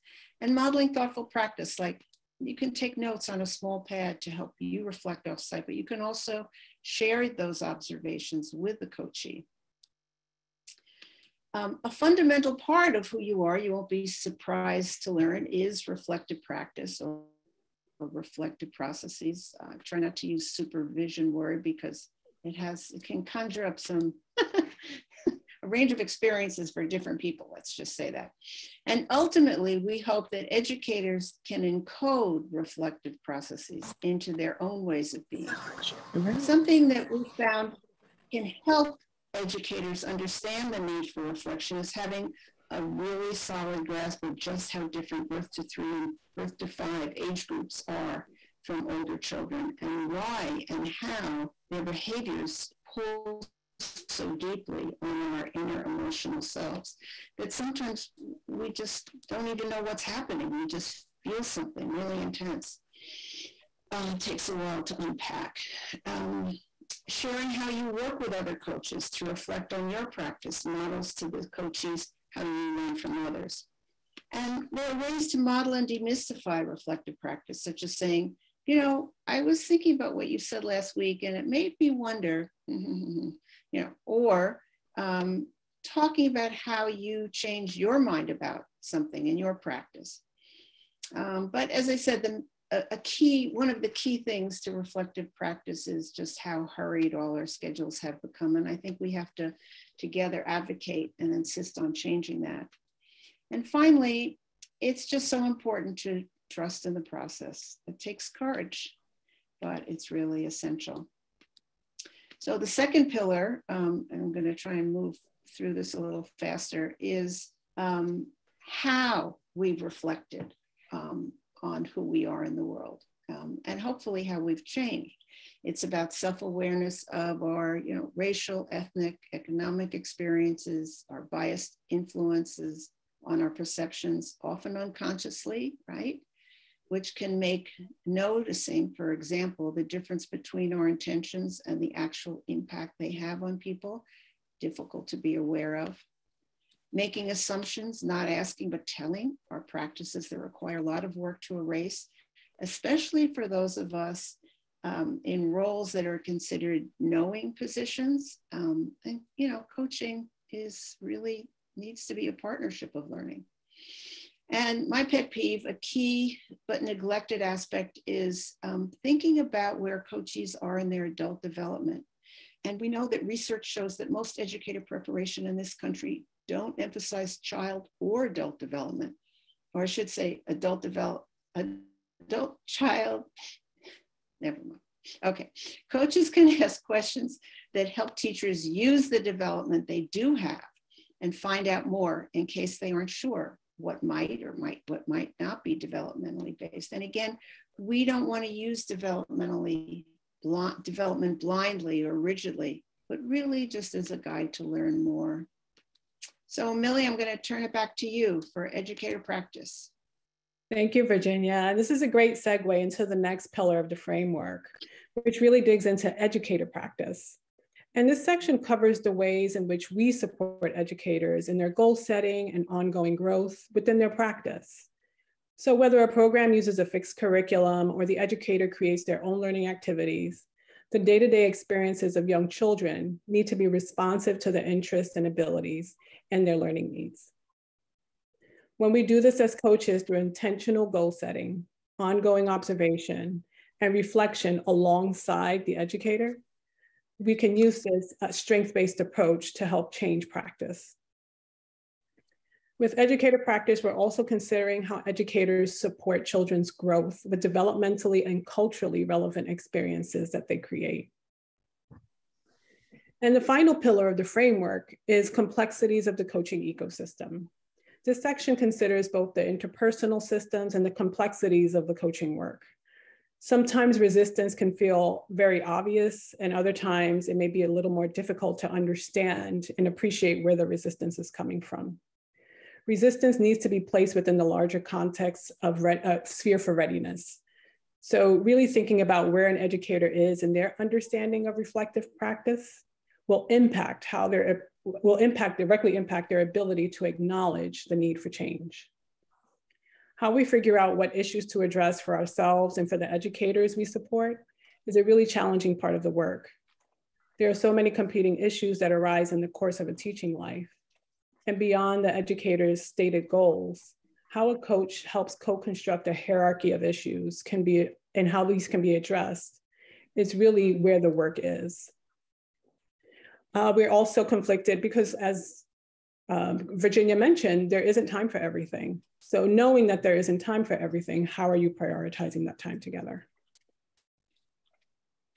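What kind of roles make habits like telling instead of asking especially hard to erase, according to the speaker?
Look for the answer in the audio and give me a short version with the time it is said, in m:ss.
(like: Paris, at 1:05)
knowing positions, at 2:36.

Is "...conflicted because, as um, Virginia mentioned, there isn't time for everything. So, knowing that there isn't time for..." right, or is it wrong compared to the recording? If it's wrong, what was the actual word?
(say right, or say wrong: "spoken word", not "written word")
right.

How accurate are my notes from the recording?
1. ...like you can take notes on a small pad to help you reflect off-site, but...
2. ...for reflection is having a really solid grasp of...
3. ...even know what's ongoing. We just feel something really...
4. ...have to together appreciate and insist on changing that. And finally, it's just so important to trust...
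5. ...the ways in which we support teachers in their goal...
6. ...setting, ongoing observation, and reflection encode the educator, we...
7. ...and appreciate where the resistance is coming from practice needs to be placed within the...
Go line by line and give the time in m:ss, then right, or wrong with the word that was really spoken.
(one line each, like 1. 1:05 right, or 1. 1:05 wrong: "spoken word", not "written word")
1. 0:01 right
2. 0:41 right
3. 0:59 wrong: "happening", not "ongoing"
4. 1:39 wrong: "advocate", not "appreciate"
5. 3:38 wrong: "educators", not "teachers"
6. 4:01 wrong: "alongside", not "encode"
7. 4:39 wrong: "resistance", not "practice".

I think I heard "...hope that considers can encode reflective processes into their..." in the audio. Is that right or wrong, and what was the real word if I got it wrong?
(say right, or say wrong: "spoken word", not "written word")
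wrong: "educators", not "considers".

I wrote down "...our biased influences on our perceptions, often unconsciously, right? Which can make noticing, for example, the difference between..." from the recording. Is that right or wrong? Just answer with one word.
right.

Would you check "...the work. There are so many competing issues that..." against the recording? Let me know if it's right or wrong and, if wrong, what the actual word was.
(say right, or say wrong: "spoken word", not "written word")
right.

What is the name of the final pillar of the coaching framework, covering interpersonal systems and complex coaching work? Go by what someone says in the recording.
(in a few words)
complexities of the coaching ecosystem.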